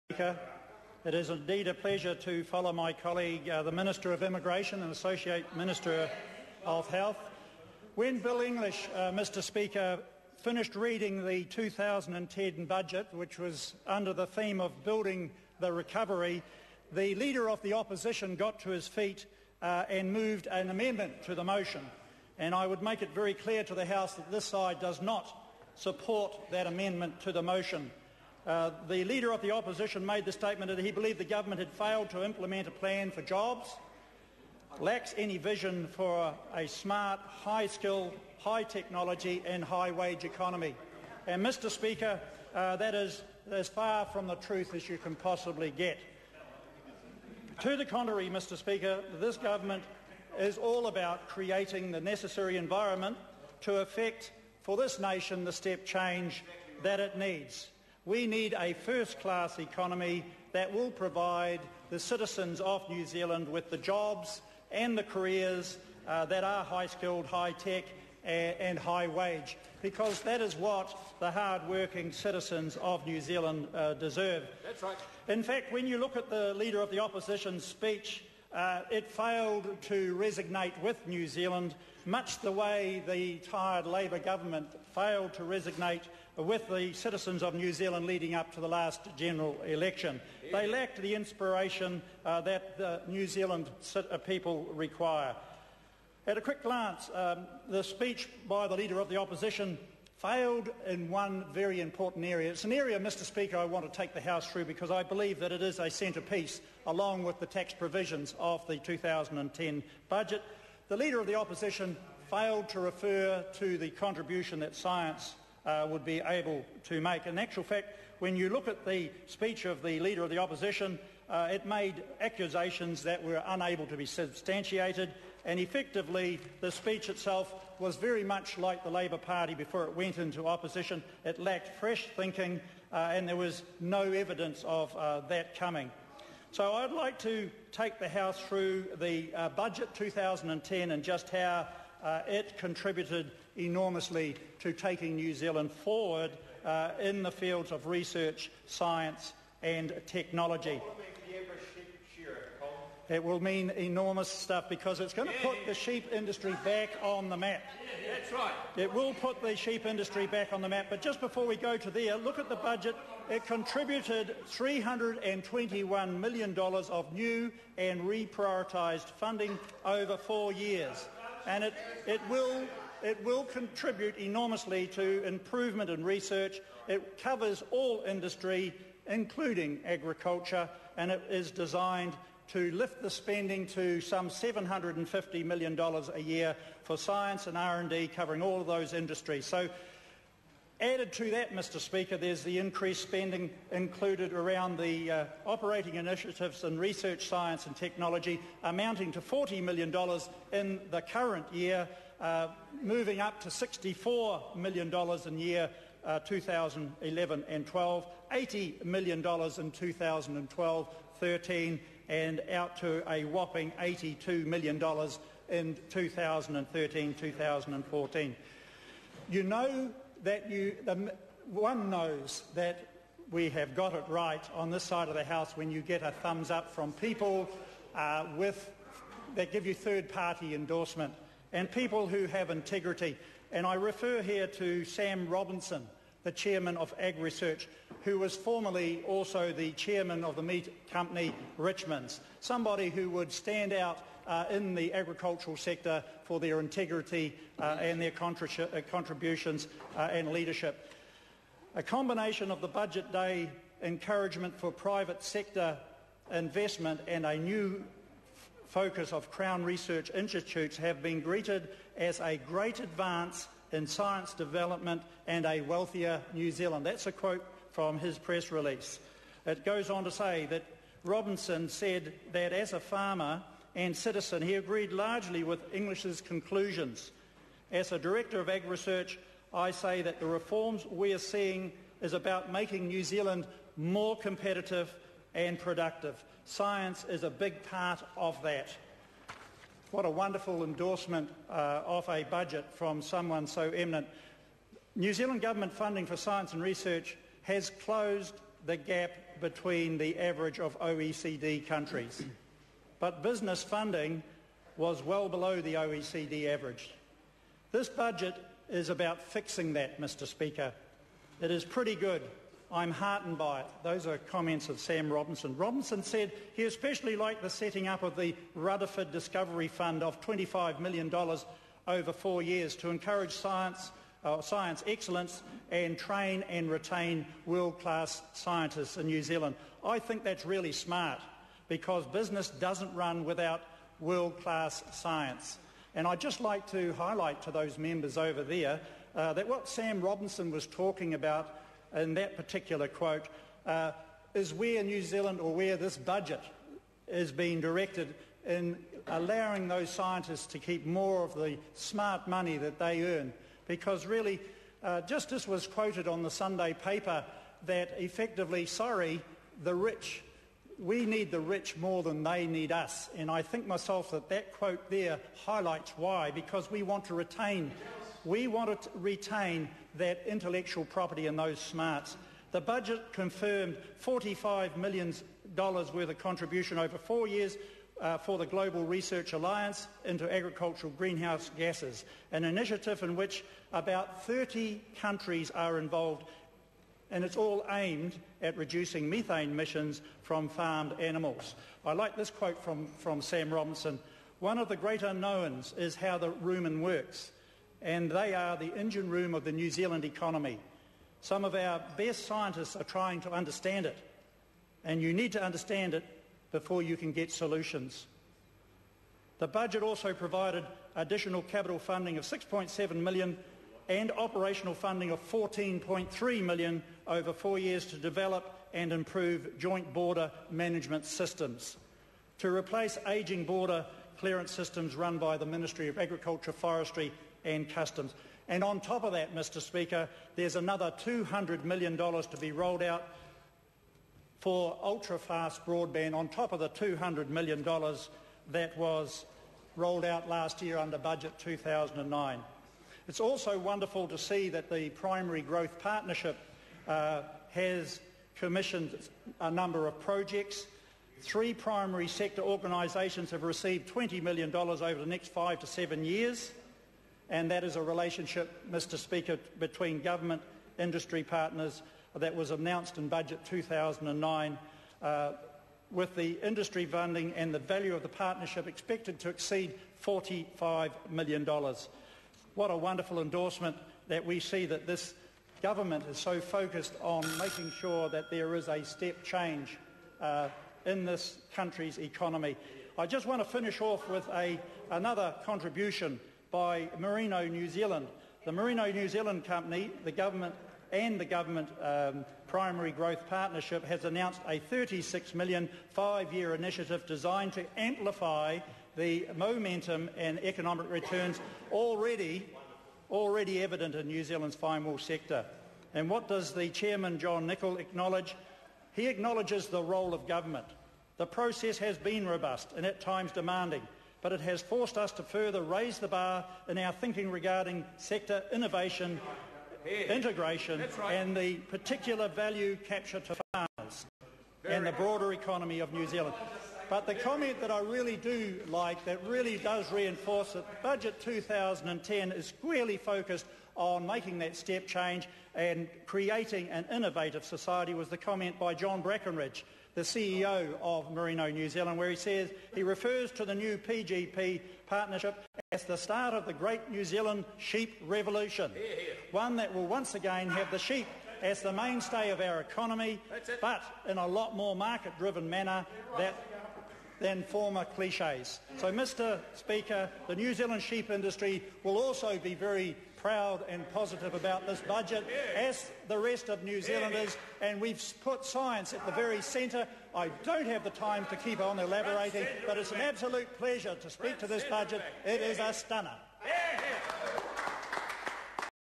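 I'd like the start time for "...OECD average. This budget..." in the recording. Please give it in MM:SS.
05:05.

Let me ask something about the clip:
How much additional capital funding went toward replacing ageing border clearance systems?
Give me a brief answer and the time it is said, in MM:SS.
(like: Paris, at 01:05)
6.7 million, at 06:52.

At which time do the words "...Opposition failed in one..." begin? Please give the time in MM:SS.
01:39.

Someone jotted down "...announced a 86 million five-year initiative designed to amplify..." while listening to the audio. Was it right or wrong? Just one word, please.
wrong.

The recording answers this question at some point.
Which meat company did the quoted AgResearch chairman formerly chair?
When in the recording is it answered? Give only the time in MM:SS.
04:01.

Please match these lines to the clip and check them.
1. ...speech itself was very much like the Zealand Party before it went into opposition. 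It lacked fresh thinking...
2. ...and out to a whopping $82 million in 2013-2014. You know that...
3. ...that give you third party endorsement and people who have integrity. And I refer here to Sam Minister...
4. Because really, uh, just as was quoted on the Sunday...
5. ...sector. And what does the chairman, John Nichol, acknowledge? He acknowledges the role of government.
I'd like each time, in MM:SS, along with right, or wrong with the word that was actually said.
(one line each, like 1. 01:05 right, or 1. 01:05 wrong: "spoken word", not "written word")
1. 02:06 wrong: "Labor", not "Zealand"
2. 03:32 right
3. 03:49 wrong: "Robinson", not "Minister"
4. 05:53 right
5. 08:24 right.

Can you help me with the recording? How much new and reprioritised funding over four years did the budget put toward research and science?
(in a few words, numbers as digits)
$321 million.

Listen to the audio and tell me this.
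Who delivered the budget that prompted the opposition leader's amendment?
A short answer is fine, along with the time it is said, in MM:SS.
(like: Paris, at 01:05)
Bill English, at 00:08.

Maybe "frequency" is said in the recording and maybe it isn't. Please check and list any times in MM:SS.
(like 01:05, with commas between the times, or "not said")
not said.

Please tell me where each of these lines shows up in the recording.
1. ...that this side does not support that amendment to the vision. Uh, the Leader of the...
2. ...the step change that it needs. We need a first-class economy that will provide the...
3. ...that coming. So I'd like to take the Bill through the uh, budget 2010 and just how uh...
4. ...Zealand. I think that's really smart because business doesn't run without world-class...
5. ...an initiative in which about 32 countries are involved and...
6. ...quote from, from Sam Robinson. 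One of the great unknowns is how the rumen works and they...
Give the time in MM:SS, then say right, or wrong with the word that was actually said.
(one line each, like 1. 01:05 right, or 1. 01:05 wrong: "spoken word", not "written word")
1. 00:24 wrong: "motion", not "vision"
2. 00:55 right
3. 02:15 wrong: "House", not "Bill"
4. 05:29 right
5. 06:22 wrong: "30", not "32"
6. 06:32 right.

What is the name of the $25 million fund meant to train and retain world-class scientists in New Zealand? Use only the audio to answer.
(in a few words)
Rutherford Discovery Fund.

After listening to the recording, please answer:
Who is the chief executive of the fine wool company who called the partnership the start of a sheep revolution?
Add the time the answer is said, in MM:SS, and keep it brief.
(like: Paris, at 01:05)
John Brackenridge, at 08:58.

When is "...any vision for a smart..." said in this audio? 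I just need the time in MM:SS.
00:35.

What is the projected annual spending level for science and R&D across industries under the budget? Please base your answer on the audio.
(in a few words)
$750 million.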